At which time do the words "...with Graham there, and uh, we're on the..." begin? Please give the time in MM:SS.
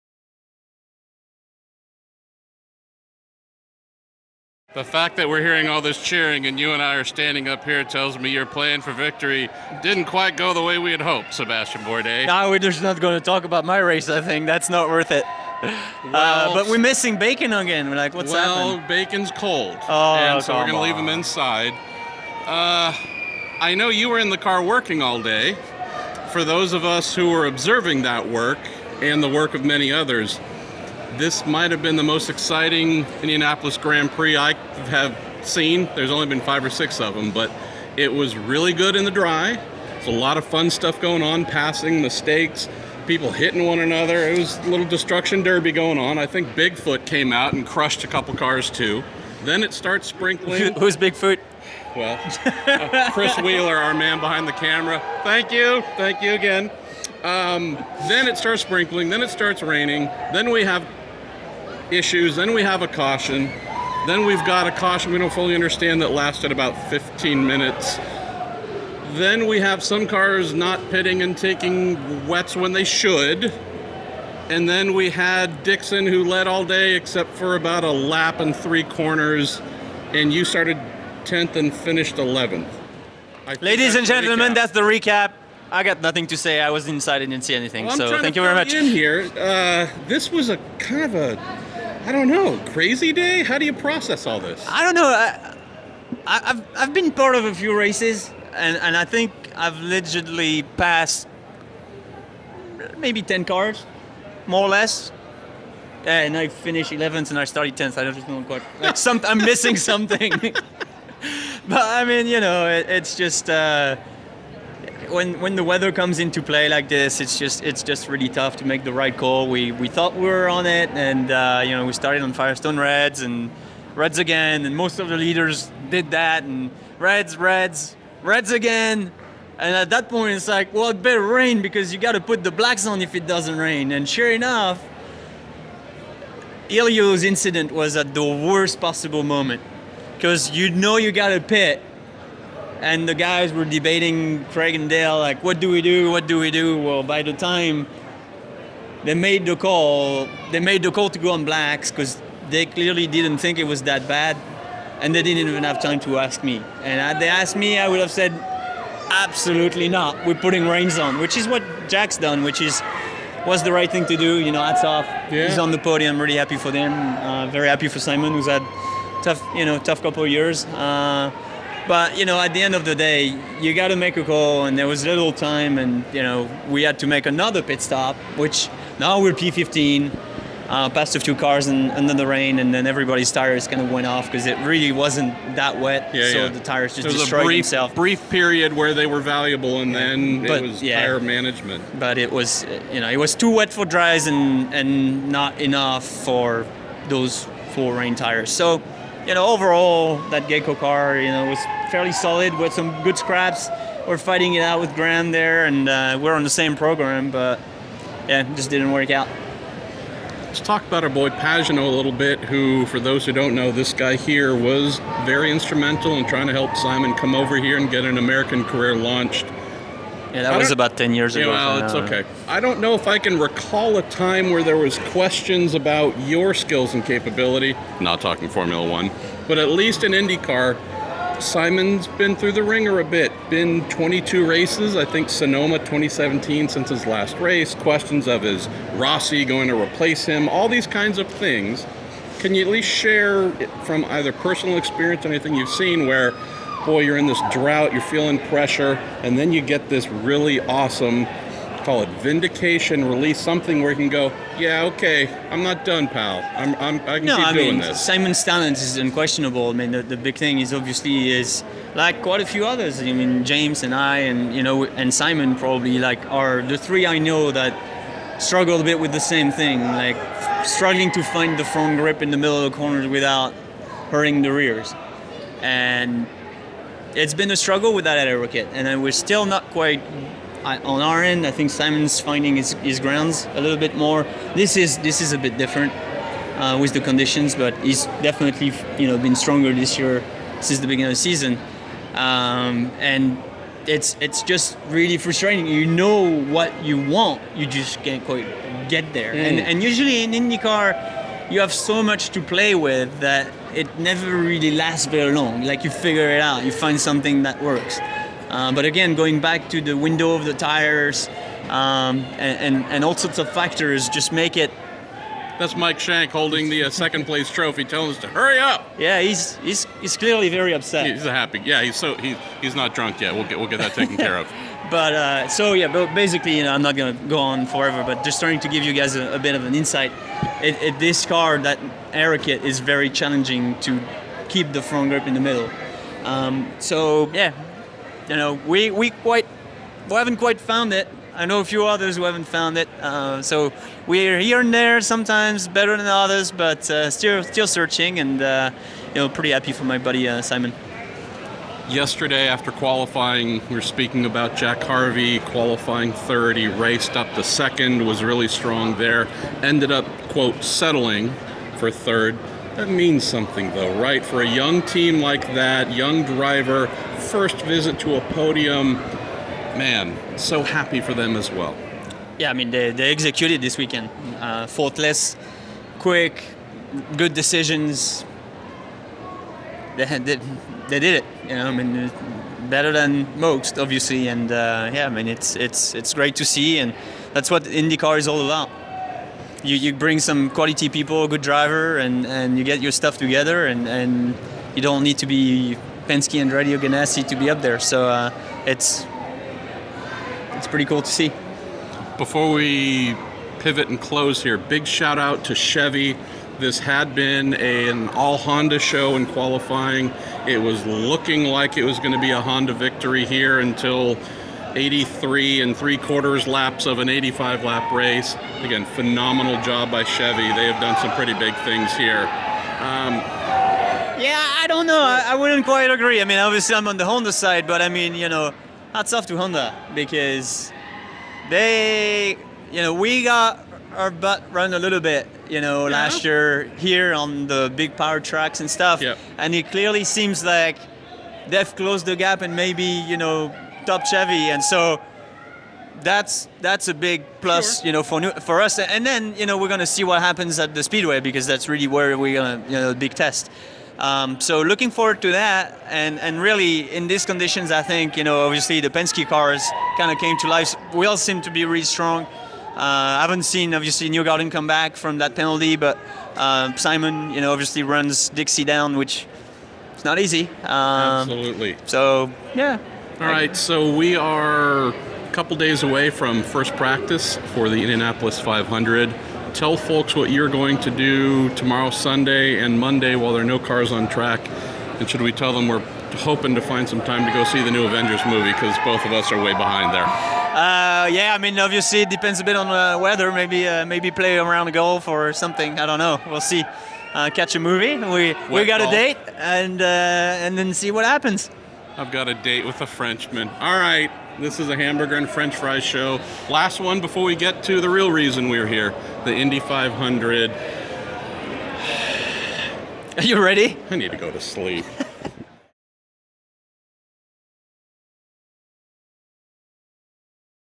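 03:24.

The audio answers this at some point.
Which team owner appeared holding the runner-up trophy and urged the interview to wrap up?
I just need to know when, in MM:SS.
05:15.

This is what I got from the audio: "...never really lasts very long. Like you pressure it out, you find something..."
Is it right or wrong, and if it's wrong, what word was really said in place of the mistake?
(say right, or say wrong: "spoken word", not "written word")
wrong: "figure", not "pressure".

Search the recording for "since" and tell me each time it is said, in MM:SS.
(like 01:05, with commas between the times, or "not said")
03:56, 04:50.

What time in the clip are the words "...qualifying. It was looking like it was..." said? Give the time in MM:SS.
06:49.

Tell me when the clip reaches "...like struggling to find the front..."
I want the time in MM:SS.
04:29.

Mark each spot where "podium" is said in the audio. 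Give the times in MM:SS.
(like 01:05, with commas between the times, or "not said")
02:45, 06:08.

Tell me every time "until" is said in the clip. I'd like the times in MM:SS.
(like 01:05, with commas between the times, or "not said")
06:53.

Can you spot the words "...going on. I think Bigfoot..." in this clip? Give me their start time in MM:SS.
00:45.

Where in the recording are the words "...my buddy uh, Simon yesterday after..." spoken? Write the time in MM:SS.
05:49.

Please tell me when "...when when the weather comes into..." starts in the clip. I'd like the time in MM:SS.
01:55.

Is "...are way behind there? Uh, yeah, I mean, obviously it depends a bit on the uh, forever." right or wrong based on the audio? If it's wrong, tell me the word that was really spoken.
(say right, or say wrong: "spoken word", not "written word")
wrong: "weather", not "forever".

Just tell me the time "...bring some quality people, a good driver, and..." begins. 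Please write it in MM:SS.
06:29.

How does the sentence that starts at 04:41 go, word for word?
I think Simon's finding his, his grounds a little bit more.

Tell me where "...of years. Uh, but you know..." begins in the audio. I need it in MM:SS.
02:50.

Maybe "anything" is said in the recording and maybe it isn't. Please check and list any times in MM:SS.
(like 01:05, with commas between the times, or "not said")
01:27, 04:05.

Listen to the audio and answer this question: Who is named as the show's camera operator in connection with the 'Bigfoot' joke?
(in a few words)
Chris Wheeler.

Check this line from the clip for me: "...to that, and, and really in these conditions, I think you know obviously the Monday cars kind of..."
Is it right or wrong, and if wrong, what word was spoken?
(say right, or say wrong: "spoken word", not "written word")
wrong: "Penske", not "Monday".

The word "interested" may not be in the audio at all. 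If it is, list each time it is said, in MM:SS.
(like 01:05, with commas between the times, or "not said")
not said.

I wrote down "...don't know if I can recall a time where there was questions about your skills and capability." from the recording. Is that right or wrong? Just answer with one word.
right.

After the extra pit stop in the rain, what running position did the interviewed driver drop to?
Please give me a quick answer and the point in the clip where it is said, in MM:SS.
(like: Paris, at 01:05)
P15, at 02:59.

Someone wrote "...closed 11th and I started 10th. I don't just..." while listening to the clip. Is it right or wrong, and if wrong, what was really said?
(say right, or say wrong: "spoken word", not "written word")
wrong: "finished", not "closed".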